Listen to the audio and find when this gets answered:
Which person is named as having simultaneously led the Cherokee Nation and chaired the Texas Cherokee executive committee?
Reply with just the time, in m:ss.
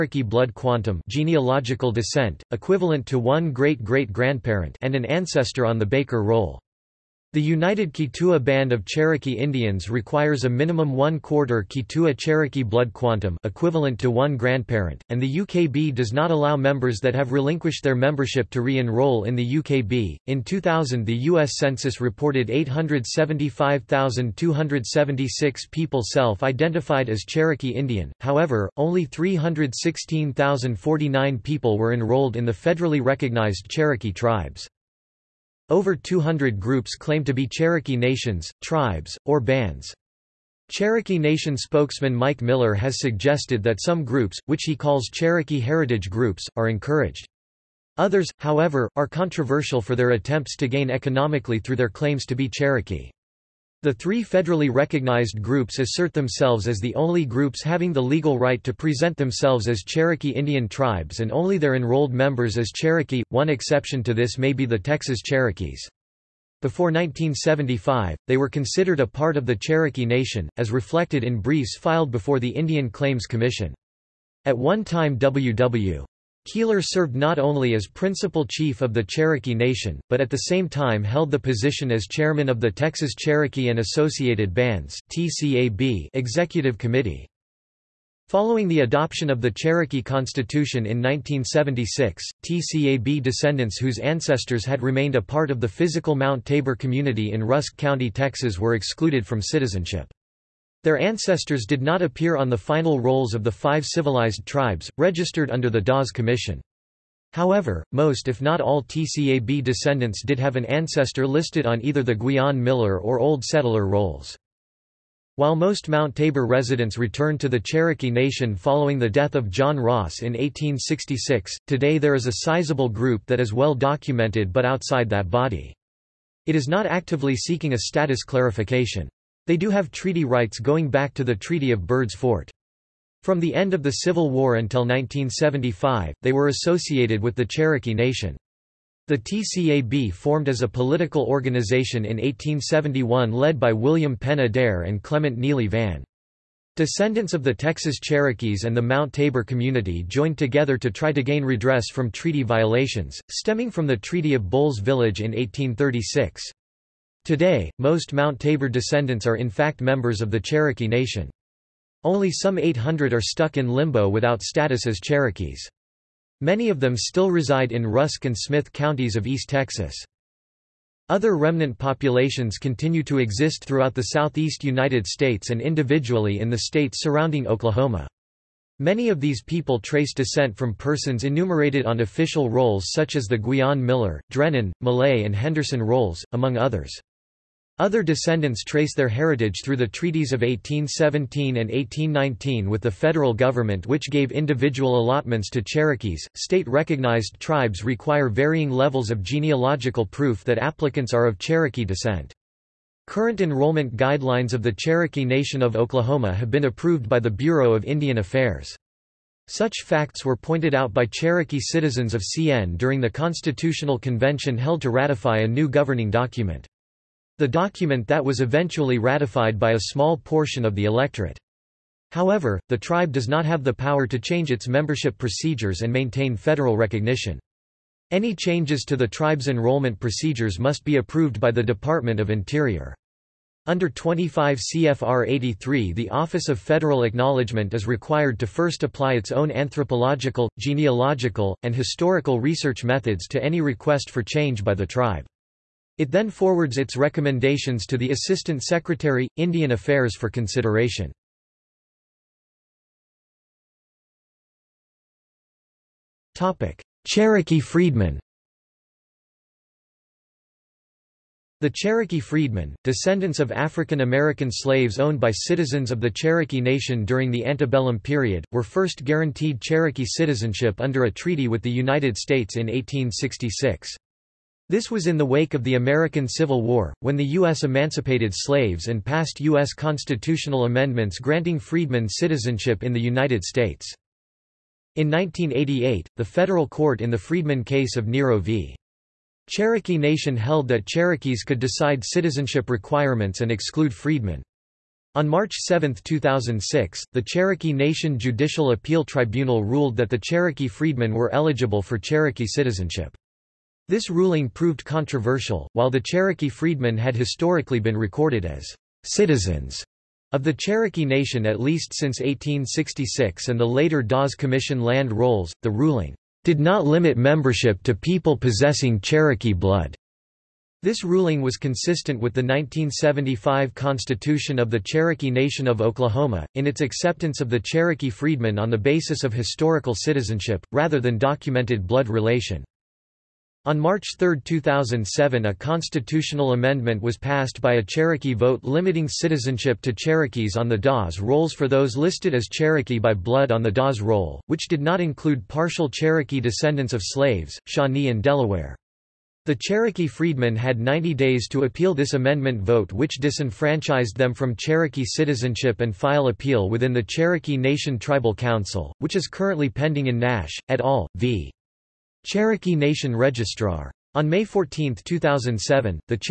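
1:15.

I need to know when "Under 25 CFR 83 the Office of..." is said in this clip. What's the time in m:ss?
3:53.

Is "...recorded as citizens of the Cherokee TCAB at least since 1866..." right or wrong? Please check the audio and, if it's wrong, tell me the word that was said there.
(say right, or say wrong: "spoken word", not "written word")
wrong: "Nation", not "TCAB".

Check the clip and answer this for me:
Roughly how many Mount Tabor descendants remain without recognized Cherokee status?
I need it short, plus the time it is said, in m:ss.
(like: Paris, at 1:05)
800, at 2:42.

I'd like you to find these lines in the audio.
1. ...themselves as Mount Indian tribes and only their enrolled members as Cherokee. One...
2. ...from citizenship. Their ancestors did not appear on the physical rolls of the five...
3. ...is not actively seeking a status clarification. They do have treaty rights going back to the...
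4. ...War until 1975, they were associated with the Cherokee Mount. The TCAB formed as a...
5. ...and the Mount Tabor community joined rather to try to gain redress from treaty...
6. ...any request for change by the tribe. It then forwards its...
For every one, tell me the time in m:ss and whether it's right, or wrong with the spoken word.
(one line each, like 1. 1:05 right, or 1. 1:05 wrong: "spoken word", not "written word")
1. 0:59 wrong: "Cherokee", not "Mount"
2. 1:39 wrong: "final", not "physical"
3. 2:06 right
4. 2:14 wrong: "Nation", not "Mount"
5. 2:28 wrong: "together", not "rather"
6. 4:03 right.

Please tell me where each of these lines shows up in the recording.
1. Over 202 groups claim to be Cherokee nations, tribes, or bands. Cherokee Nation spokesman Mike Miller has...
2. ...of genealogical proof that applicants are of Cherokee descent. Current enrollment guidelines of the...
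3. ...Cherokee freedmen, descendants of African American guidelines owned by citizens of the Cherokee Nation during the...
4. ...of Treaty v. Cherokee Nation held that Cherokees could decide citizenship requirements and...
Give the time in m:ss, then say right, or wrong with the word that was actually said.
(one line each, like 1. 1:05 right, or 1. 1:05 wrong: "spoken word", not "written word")
1. 0:35 wrong: "200", not "202"
2. 3:19 right
3. 4:21 wrong: "slaves", not "guidelines"
4. 4:47 wrong: "Nero", not "Treaty".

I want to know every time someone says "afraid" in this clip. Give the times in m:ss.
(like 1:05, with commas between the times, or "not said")
not said.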